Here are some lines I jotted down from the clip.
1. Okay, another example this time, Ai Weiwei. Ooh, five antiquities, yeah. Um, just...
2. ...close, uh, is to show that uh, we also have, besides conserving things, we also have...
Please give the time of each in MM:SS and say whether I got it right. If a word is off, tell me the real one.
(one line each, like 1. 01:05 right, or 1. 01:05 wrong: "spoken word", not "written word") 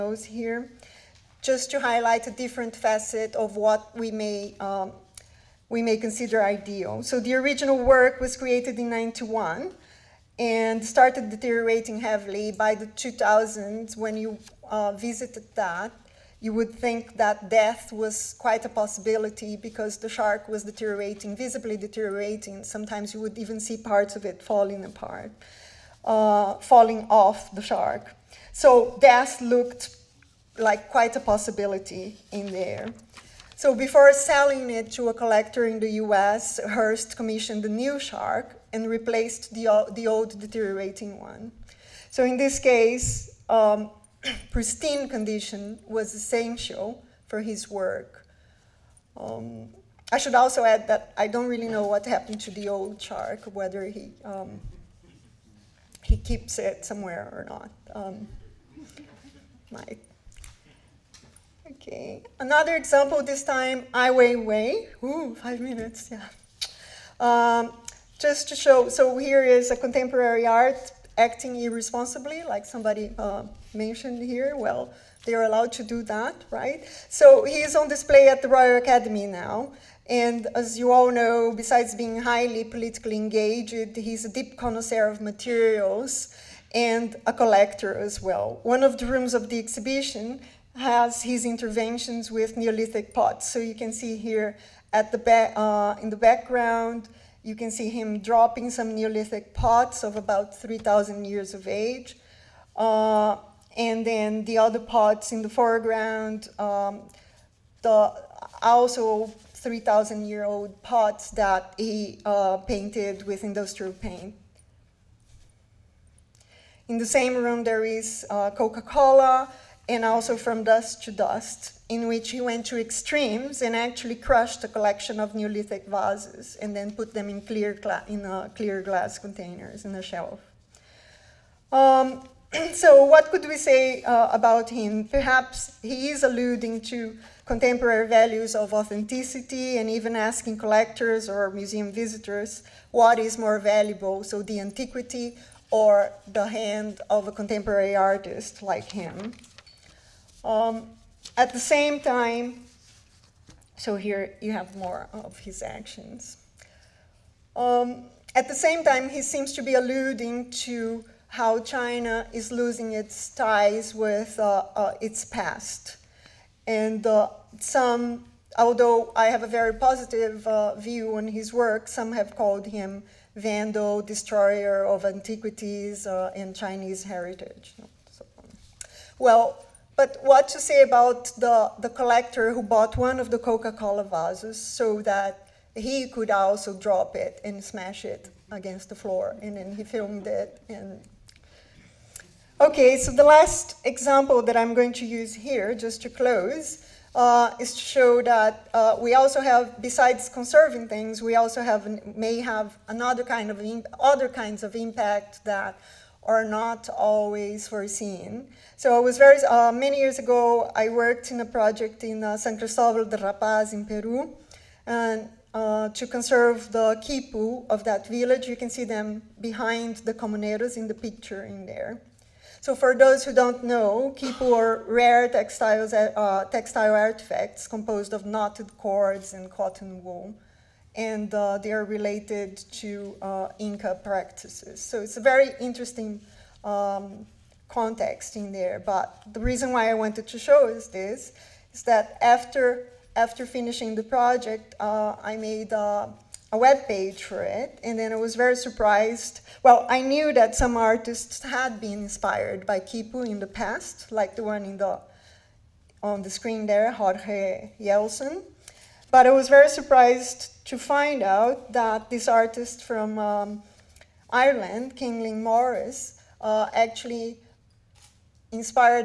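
1. 01:01 wrong: "minutes", not "antiquities"
2. 03:16 right.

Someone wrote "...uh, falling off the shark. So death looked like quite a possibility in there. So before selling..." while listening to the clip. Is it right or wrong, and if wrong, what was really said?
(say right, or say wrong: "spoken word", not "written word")
right.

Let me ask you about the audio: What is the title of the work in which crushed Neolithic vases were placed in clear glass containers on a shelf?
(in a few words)
From Dust to Dust.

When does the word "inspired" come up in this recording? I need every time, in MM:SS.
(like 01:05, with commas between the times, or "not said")
04:12, 04:28.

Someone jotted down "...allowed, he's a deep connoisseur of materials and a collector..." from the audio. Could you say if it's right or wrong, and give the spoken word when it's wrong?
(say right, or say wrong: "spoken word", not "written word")
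wrong: "engaged", not "allowed".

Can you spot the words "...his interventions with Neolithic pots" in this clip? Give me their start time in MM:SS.
01:31.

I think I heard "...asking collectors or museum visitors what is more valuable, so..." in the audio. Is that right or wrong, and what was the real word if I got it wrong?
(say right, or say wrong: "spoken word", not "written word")
right.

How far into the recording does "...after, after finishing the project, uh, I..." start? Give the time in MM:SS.
04:02.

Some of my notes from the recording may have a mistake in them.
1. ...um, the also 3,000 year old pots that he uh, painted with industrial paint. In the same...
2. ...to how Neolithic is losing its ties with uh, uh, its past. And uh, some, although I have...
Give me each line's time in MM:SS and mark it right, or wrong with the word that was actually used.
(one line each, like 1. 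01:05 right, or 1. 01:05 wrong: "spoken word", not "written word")
1. 01:46 right
2. 02:40 wrong: "China", not "Neolithic".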